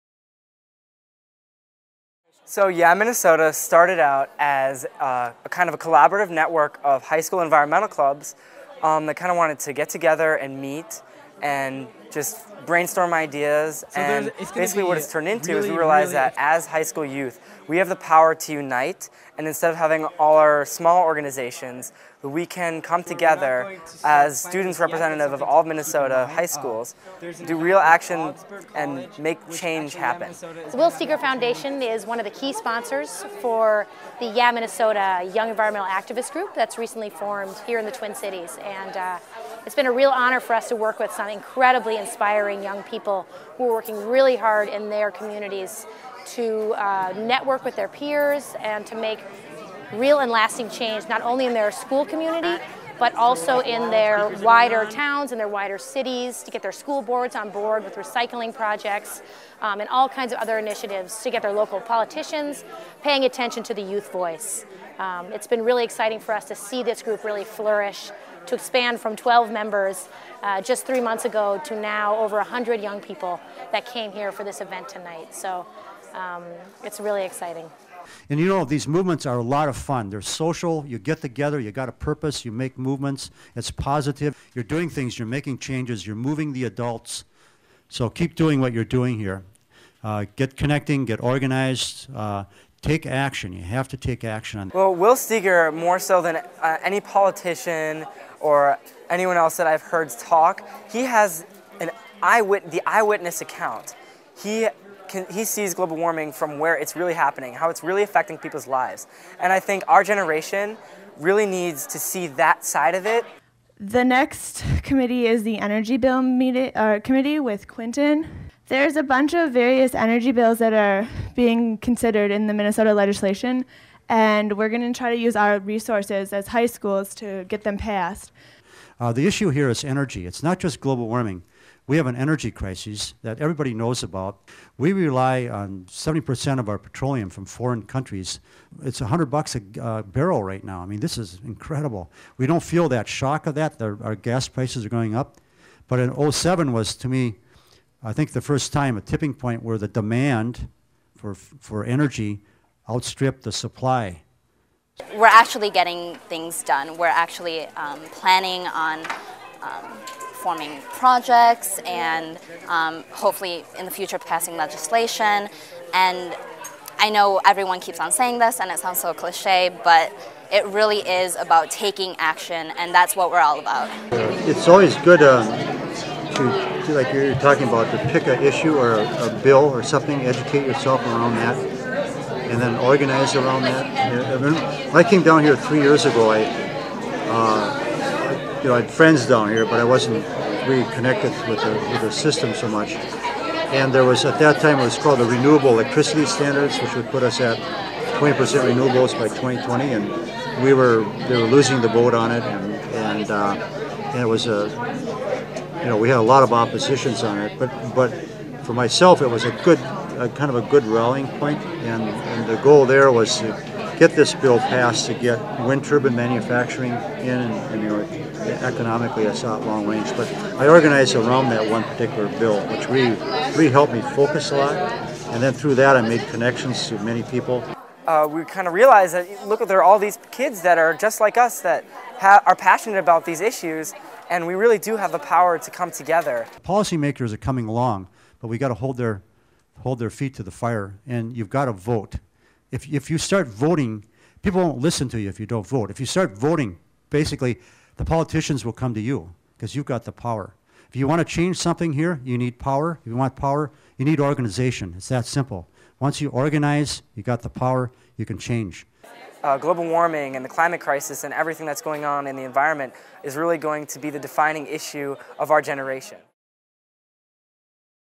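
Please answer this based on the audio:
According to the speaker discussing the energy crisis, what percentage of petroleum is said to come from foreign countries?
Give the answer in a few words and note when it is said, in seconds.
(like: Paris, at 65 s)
70%, at 135 s.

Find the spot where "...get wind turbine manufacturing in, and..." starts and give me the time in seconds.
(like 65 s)
215 s.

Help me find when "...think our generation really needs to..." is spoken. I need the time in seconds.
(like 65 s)
109 s.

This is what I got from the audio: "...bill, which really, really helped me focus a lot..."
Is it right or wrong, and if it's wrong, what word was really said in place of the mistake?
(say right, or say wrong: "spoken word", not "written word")
right.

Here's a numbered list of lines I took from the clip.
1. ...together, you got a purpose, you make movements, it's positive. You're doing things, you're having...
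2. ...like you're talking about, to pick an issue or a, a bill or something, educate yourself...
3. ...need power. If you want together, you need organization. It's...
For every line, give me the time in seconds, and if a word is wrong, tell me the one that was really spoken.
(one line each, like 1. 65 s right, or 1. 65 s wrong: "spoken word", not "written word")
1. 81 s wrong: "making", not "having"
2. 176 s right
3. 252 s wrong: "power", not "together".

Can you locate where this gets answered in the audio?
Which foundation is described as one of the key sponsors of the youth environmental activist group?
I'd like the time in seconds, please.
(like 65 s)
30 s.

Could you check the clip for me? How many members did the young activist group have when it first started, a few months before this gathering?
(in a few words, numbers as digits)
12.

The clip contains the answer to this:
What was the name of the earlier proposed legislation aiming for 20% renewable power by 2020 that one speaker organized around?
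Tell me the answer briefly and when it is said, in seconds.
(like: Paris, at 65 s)
Renewable Electricity Standards, at 195 s.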